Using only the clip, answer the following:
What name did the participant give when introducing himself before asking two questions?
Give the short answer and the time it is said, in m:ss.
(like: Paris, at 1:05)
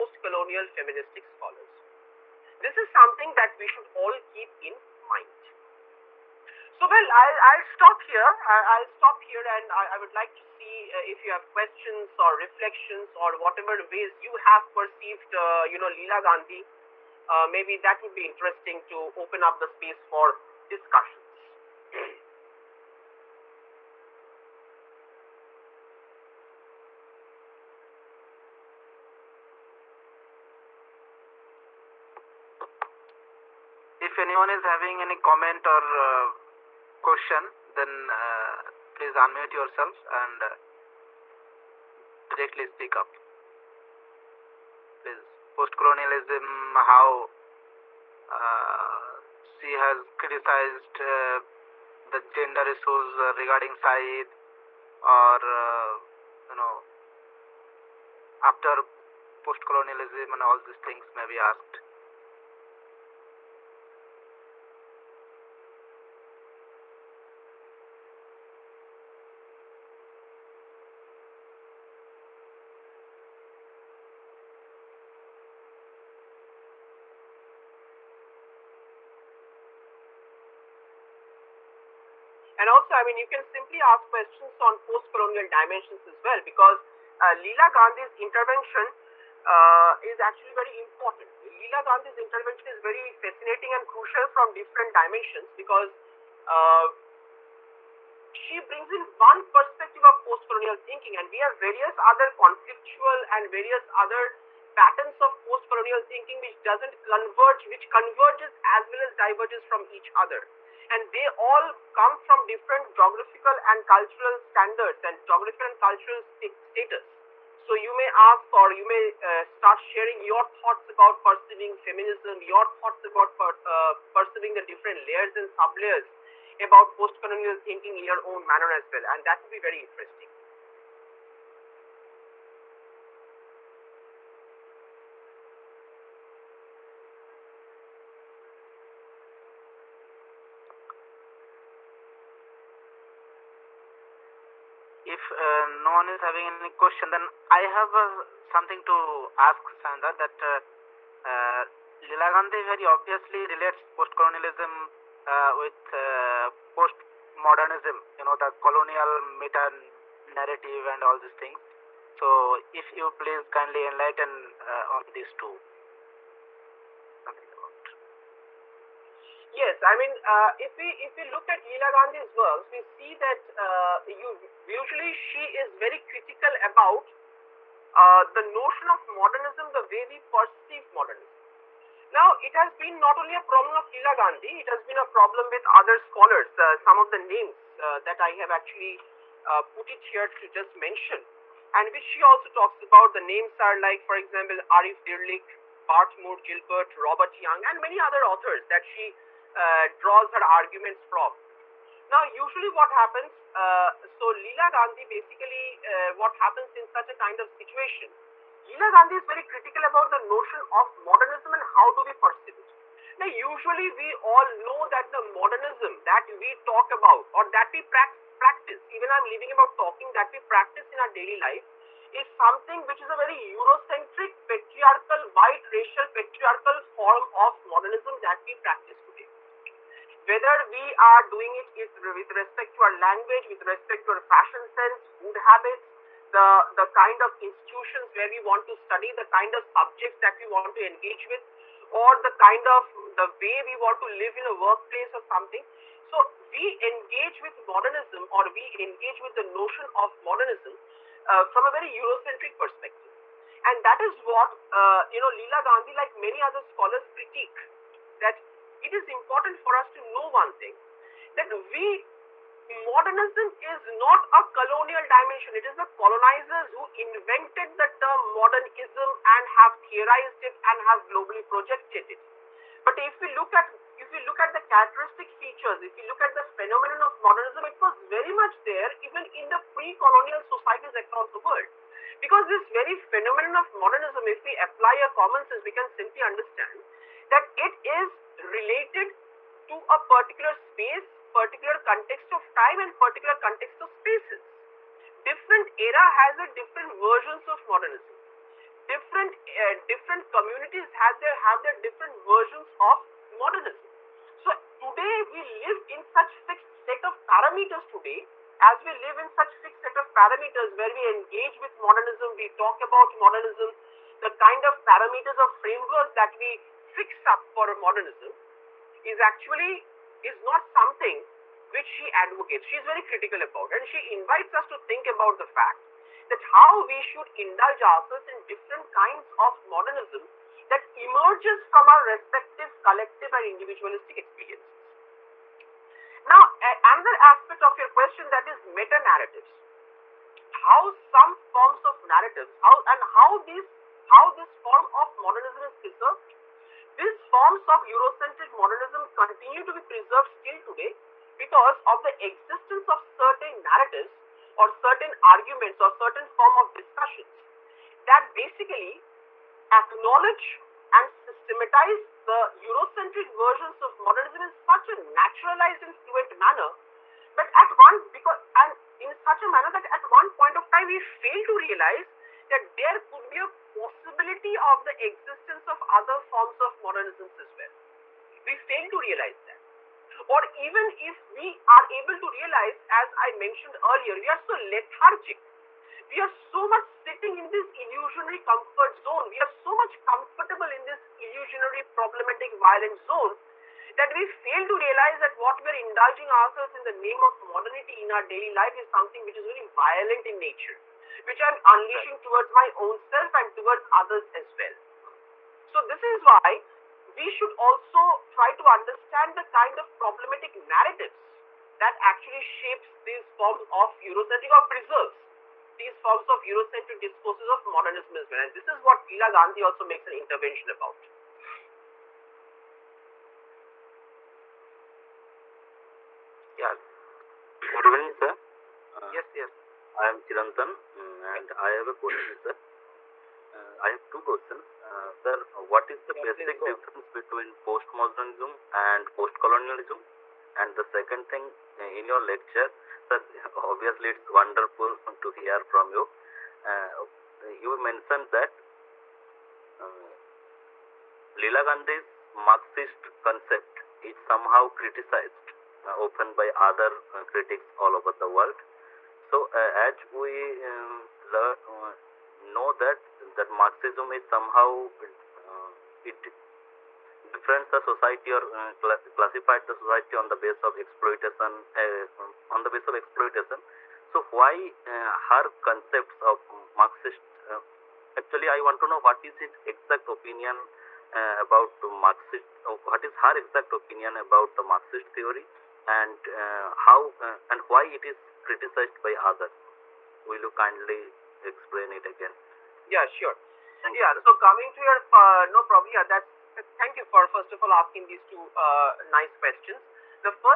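Chirantan, at 7:10.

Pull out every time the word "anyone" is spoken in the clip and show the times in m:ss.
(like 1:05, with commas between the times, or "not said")
0:34.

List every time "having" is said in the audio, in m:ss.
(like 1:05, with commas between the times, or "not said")
0:34, 2:26.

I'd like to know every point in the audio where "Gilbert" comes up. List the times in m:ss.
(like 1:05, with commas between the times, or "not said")
3:16.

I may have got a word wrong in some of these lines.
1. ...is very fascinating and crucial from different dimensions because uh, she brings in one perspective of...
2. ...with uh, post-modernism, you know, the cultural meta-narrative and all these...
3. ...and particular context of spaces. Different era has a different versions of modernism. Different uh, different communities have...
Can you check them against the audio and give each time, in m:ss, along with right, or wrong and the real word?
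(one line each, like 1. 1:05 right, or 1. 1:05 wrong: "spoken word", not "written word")
1. 1:32 right
2. 2:35 wrong: "colonial", not "cultural"
3. 4:52 right.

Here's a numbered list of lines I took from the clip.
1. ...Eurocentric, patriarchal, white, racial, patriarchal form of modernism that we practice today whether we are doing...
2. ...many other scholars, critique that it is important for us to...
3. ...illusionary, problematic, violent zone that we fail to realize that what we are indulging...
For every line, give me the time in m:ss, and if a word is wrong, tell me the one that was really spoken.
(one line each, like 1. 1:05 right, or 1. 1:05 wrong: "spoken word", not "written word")
1. 3:43 right
2. 4:16 right
3. 6:31 right.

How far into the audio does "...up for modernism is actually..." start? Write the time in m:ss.
5:17.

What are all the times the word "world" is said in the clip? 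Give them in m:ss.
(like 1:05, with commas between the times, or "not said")
4:41, 7:38.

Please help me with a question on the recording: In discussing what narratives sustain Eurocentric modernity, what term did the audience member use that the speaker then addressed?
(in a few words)
meta narratives.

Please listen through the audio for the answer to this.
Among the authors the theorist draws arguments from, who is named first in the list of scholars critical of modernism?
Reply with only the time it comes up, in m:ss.
3:14.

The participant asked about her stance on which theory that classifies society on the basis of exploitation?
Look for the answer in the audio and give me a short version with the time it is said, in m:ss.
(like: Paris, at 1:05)
Marxist theory, at 8:04.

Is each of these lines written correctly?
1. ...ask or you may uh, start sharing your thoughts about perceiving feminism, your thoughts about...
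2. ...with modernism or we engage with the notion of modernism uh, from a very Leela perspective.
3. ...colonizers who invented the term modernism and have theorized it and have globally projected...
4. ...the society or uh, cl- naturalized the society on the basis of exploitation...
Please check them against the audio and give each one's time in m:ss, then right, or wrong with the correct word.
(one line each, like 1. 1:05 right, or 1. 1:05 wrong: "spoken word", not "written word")
1. 1:58 right
2. 4:07 wrong: "Eurocentric", not "Leela"
3. 4:26 right
4. 7:47 wrong: "classified", not "naturalized".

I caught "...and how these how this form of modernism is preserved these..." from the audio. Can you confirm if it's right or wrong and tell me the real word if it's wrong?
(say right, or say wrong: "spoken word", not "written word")
right.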